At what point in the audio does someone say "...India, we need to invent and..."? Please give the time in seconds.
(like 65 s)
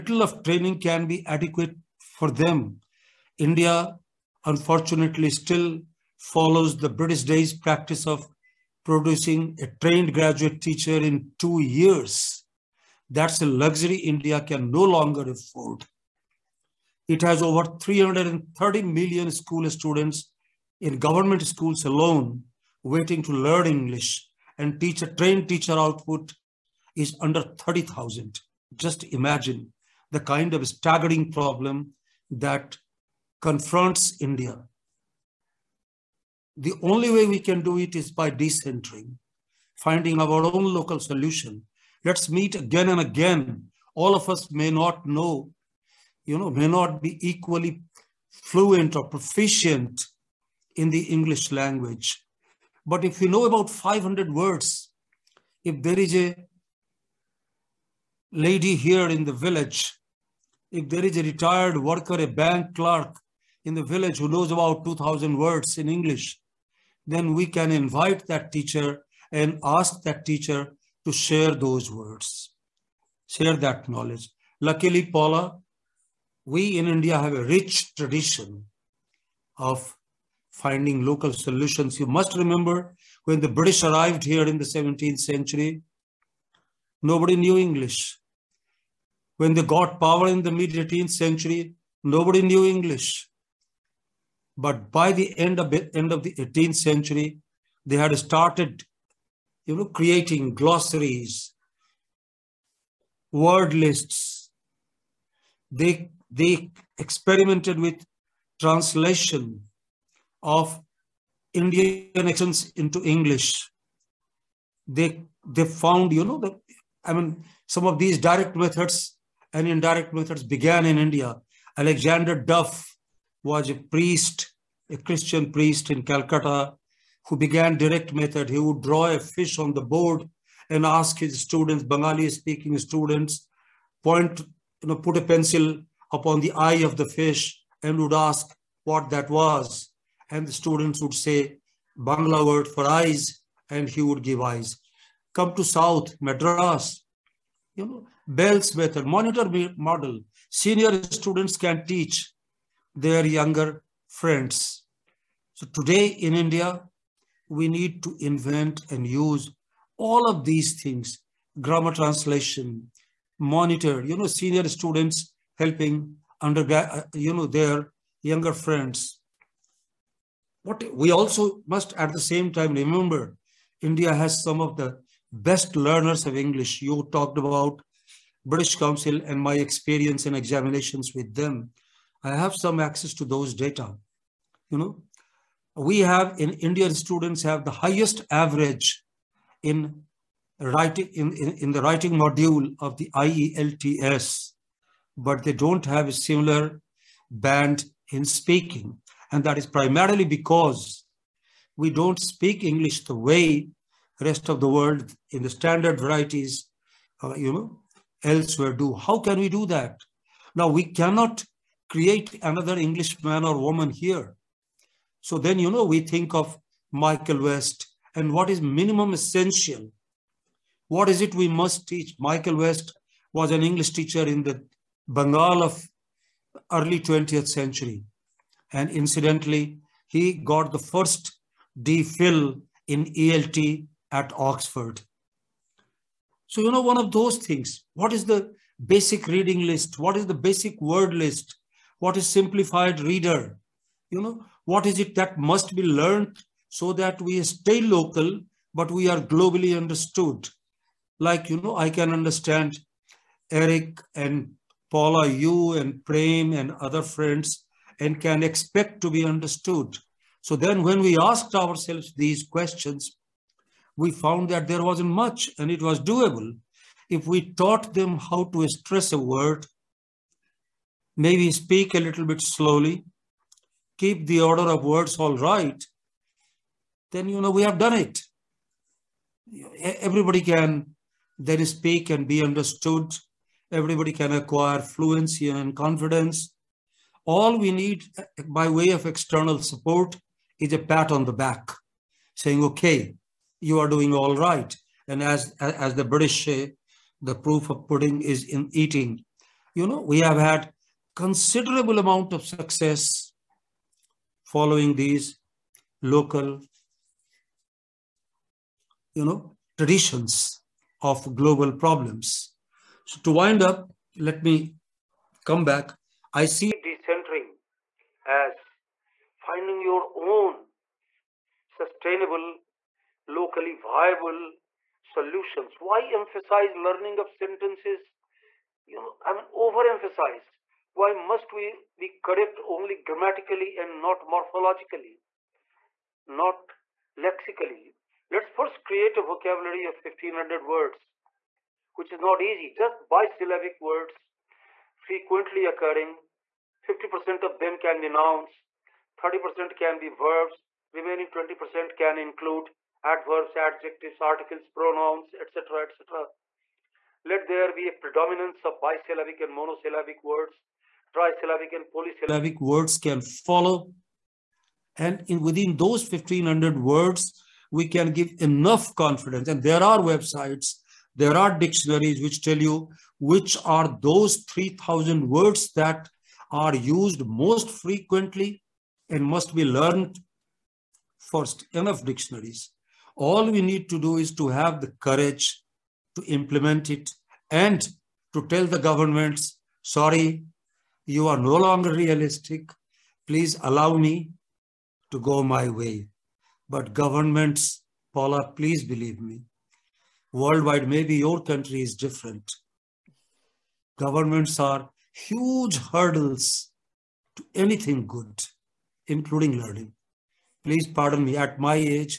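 156 s.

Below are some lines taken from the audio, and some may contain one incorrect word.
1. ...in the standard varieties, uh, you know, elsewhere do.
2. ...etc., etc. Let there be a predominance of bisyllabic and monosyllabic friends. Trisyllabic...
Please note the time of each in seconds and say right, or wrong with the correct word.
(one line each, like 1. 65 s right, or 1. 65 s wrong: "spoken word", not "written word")
1. 205 s right
2. 355 s wrong: "words", not "friends".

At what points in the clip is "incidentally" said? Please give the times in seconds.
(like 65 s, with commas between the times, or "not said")
228 s.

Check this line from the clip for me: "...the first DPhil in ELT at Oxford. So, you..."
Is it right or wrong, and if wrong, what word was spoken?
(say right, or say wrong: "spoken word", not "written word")
right.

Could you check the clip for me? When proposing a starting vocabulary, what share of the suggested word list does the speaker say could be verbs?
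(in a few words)
30%.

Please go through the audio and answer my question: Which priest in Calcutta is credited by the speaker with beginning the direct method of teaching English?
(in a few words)
Alexander Duff.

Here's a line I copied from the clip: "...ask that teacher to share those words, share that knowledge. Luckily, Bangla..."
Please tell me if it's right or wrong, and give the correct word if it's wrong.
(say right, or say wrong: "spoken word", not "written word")
wrong: "Paula", not "Bangla".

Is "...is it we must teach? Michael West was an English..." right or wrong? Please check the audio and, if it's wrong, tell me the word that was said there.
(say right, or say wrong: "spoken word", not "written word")
right.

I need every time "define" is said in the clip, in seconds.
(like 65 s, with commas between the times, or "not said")
not said.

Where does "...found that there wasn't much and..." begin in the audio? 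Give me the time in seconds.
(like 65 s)
264 s.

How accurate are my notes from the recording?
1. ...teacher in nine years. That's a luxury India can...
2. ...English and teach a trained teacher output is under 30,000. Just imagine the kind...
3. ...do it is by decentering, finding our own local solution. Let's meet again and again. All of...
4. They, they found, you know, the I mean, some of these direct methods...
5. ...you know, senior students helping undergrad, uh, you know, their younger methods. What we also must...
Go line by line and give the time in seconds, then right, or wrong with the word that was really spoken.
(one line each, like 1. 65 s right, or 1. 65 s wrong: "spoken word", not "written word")
1. 10 s wrong: "two", not "nine"
2. 23 s right
3. 37 s right
4. 114 s right
5. 164 s wrong: "friends", not "methods".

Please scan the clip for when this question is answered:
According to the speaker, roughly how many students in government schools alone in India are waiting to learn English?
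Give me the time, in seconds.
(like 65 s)
17 s.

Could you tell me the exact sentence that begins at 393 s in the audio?
Please allow me to go my way.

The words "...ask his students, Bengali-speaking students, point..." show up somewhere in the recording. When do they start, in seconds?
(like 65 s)
130 s.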